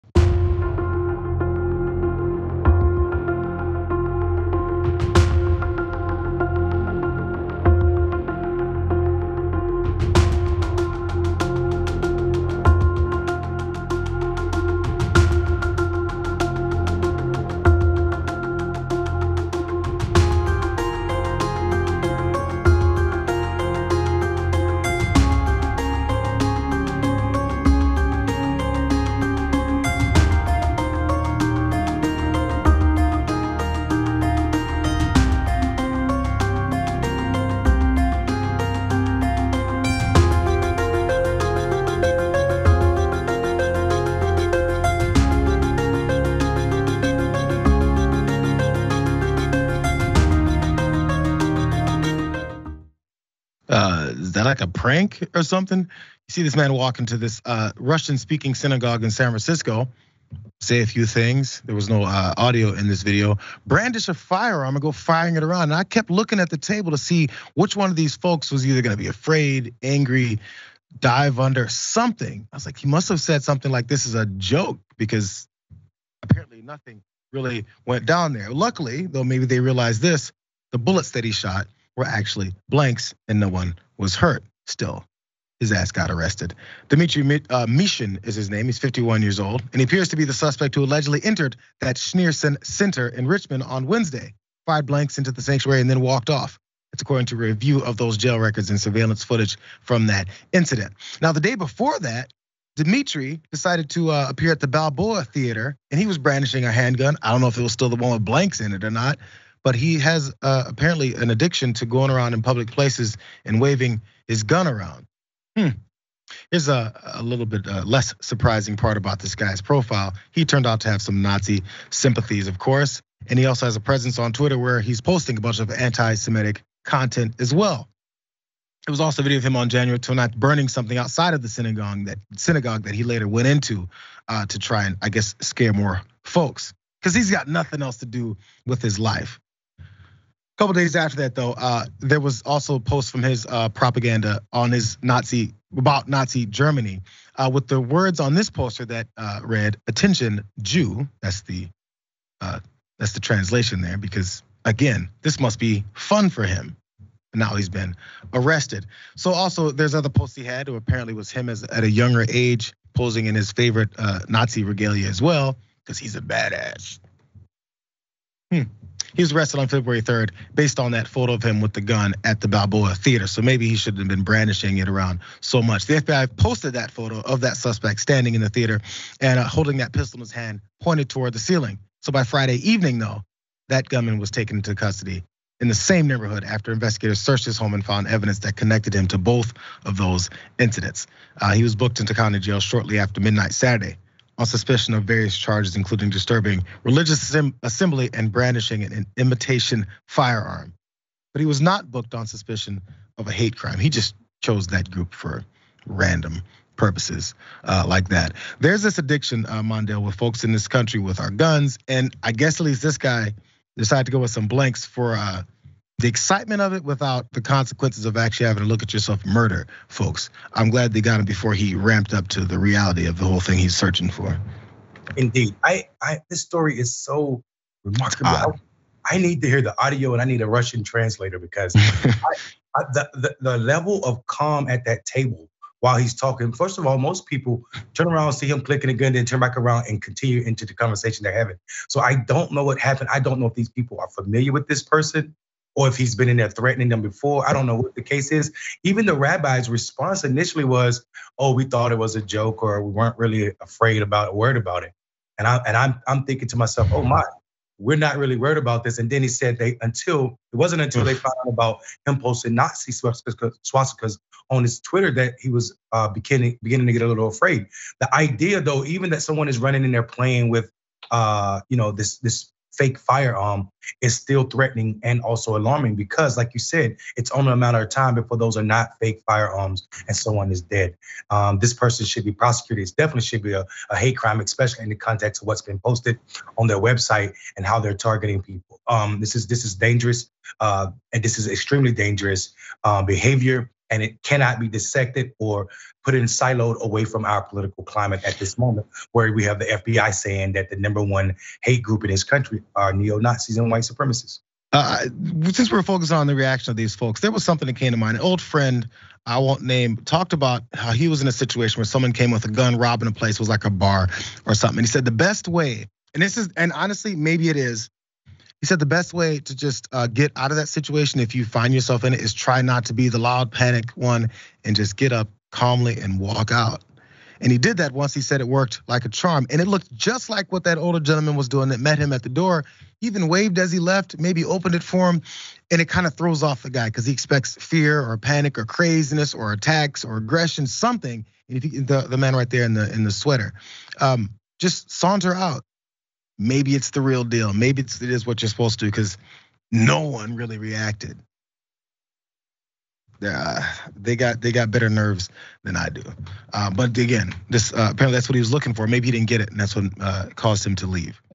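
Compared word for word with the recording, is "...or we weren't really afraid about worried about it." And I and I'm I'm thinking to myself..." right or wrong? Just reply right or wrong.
right.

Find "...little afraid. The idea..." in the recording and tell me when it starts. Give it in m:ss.
4:27.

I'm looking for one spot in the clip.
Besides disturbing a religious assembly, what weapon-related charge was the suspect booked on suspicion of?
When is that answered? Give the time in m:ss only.
3:18.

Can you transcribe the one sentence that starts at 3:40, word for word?
I'm glad they got him before he ramped up to the reality of the whole thing he's searching for.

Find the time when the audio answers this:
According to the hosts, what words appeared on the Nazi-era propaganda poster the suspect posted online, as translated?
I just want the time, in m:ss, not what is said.
2:29.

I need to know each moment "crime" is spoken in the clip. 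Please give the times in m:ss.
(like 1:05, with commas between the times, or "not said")
3:23, 4:44.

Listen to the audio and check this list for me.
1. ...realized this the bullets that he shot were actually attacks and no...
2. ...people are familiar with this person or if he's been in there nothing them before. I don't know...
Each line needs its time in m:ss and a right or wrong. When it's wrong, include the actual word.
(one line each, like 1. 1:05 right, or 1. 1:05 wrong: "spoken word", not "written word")
1. 1:19 wrong: "blanks", not "attacks"
2. 4:03 wrong: "threatening", not "nothing".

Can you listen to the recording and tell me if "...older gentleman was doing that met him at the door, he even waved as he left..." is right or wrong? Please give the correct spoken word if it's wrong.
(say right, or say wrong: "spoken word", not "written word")
right.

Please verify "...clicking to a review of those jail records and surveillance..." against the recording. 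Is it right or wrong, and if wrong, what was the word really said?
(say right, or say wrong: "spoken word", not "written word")
wrong: "according", not "clicking".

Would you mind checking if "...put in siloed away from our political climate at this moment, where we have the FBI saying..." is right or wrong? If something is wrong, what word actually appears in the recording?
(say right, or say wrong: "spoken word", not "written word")
right.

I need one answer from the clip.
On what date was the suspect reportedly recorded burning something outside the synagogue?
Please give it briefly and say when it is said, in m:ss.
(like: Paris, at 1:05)
January 29th, at 2:09.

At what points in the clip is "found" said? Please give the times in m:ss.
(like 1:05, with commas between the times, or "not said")
3:07, 4:21.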